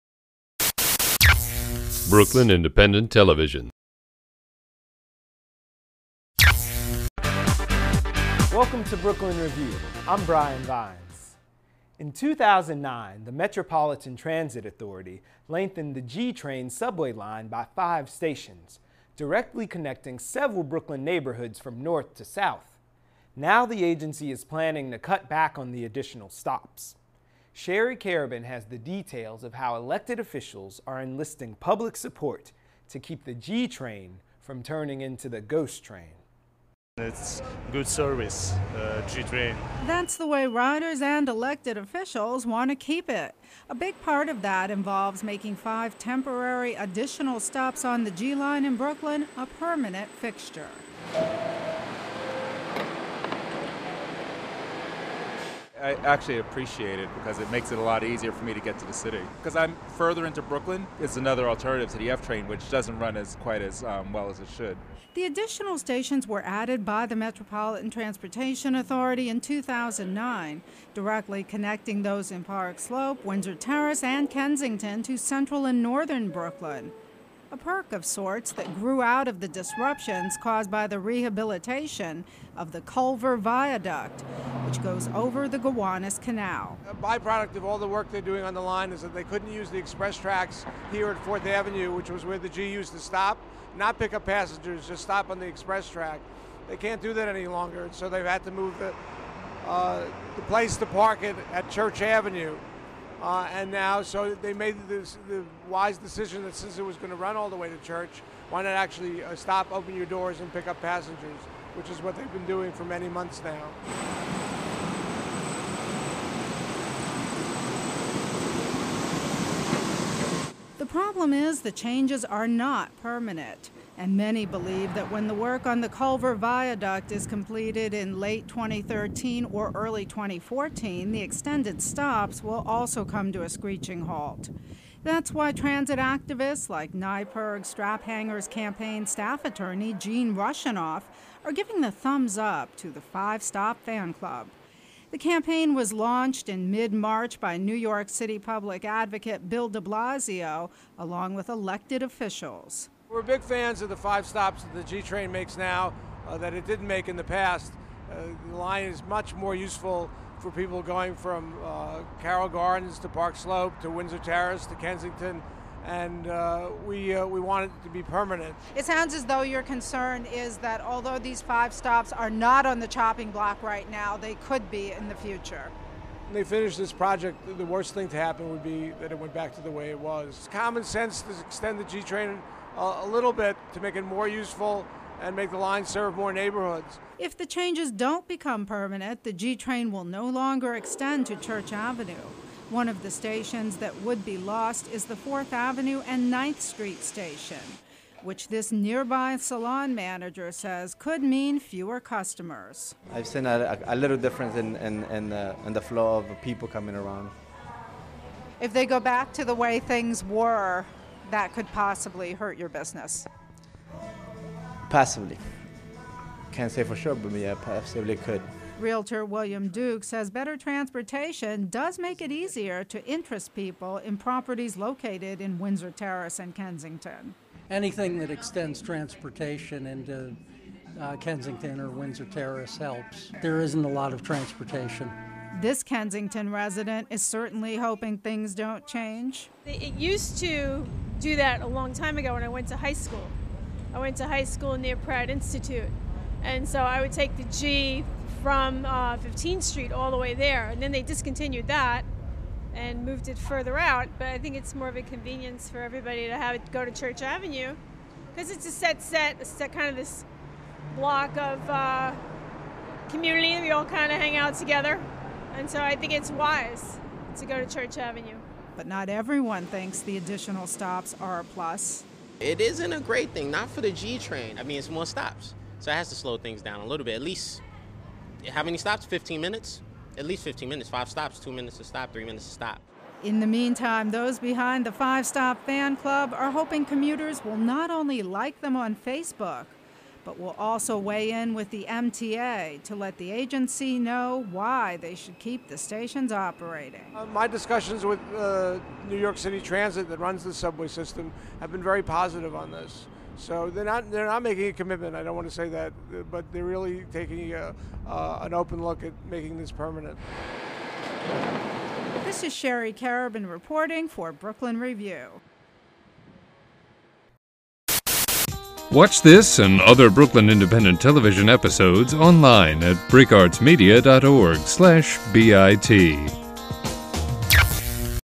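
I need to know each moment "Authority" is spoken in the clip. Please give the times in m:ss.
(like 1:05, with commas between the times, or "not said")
0:14, 1:08.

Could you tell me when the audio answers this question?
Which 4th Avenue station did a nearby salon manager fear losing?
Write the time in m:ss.
3:15.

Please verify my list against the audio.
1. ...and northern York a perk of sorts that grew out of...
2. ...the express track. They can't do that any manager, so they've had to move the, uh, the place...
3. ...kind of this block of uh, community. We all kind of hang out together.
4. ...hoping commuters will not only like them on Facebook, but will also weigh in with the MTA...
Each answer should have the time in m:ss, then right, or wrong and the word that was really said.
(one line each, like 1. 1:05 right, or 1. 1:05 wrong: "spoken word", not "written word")
1. 1:15 wrong: "Brooklyn", not "York"
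2. 1:35 wrong: "longer", not "manager"
3. 4:19 right
4. 4:46 right.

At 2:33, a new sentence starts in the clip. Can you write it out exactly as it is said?
We're big fans of the five stops that the G train makes now uh, that it didn't make in the past.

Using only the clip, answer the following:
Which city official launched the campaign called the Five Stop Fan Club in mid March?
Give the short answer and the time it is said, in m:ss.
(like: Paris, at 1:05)
Bill de Blasio, at 2:29.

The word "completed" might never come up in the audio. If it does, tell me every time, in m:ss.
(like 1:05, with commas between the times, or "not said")
2:07.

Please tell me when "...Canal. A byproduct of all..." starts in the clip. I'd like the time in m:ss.
1:26.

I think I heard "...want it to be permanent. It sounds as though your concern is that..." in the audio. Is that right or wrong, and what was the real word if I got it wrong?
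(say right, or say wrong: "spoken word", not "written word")
right.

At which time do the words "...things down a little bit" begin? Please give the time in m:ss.
4:36.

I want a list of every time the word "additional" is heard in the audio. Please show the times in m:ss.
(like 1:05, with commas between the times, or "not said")
0:25, 0:46, 1:05, 4:30.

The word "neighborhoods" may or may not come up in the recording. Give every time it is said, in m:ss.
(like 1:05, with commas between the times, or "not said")
0:21, 3:06.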